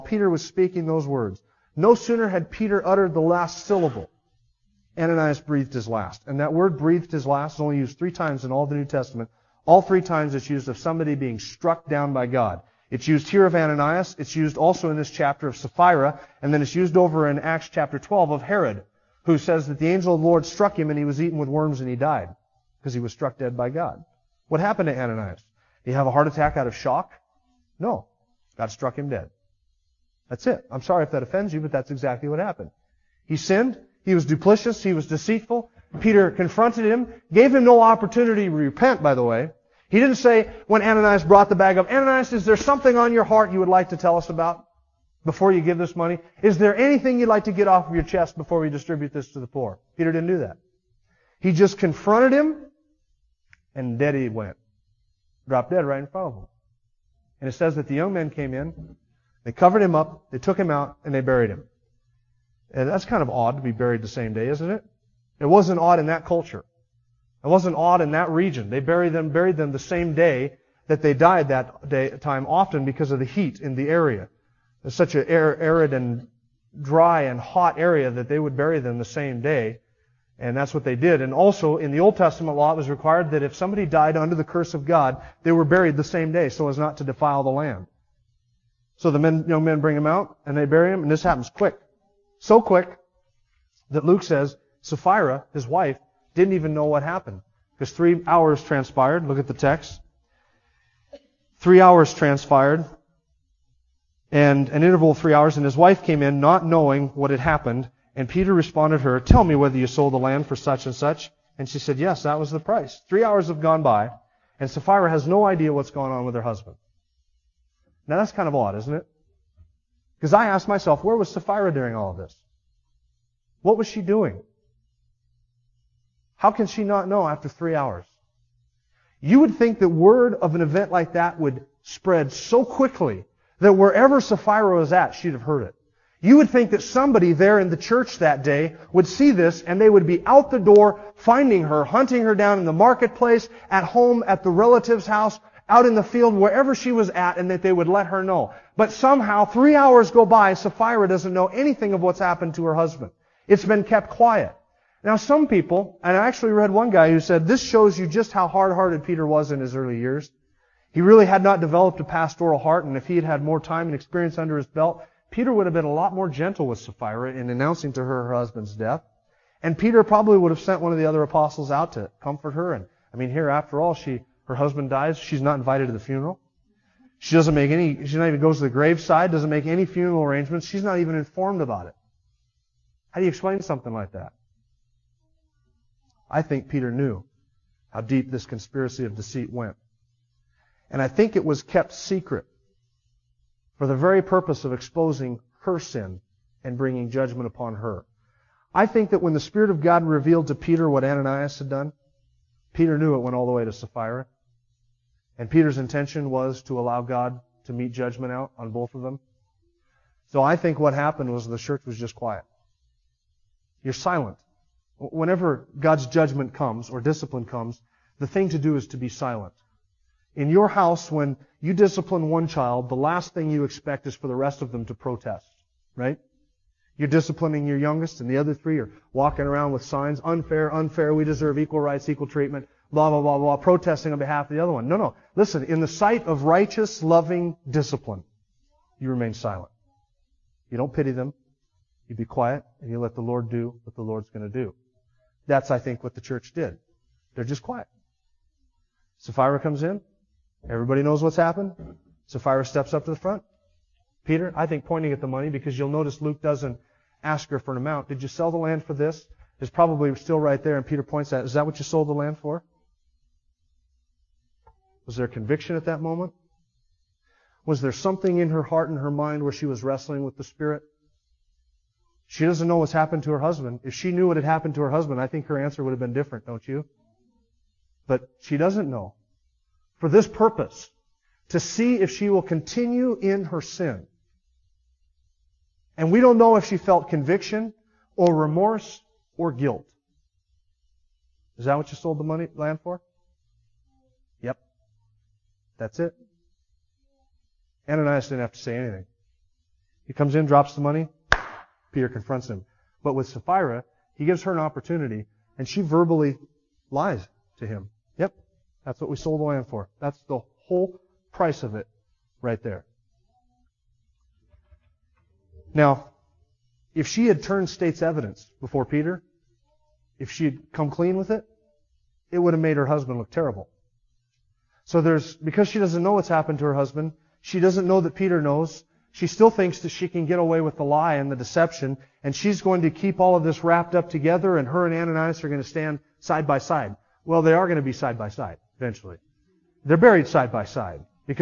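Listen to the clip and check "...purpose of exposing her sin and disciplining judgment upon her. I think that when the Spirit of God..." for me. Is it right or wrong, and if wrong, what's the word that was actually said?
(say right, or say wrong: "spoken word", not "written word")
wrong: "bringing", not "disciplining".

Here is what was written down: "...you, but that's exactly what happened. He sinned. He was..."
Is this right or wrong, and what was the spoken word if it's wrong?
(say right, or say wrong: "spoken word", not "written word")
right.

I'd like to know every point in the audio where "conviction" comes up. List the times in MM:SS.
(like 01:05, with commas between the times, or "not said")
04:25, 04:47.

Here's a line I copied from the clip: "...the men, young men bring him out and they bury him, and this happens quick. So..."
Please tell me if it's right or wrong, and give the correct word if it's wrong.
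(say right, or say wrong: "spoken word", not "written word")
right.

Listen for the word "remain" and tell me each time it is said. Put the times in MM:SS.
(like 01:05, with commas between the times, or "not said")
03:59.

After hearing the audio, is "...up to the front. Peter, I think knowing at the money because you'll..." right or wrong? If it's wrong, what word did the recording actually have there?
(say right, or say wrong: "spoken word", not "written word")
wrong: "pointing", not "knowing".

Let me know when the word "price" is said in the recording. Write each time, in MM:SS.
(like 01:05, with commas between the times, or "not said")
01:52, 05:11.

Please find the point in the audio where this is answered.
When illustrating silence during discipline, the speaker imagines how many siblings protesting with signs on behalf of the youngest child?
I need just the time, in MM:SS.
03:48.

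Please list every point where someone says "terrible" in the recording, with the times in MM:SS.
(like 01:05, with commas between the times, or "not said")
05:23.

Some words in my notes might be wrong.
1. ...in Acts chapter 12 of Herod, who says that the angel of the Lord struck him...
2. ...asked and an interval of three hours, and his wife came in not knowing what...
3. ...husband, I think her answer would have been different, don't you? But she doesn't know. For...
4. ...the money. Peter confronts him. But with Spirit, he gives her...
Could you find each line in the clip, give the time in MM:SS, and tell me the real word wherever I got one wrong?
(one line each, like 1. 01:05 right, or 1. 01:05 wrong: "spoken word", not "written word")
1. 00:17 right
2. 01:42 wrong: "transpired", not "asked"
3. 04:34 right
4. 05:00 wrong: "Sapphira", not "Spirit".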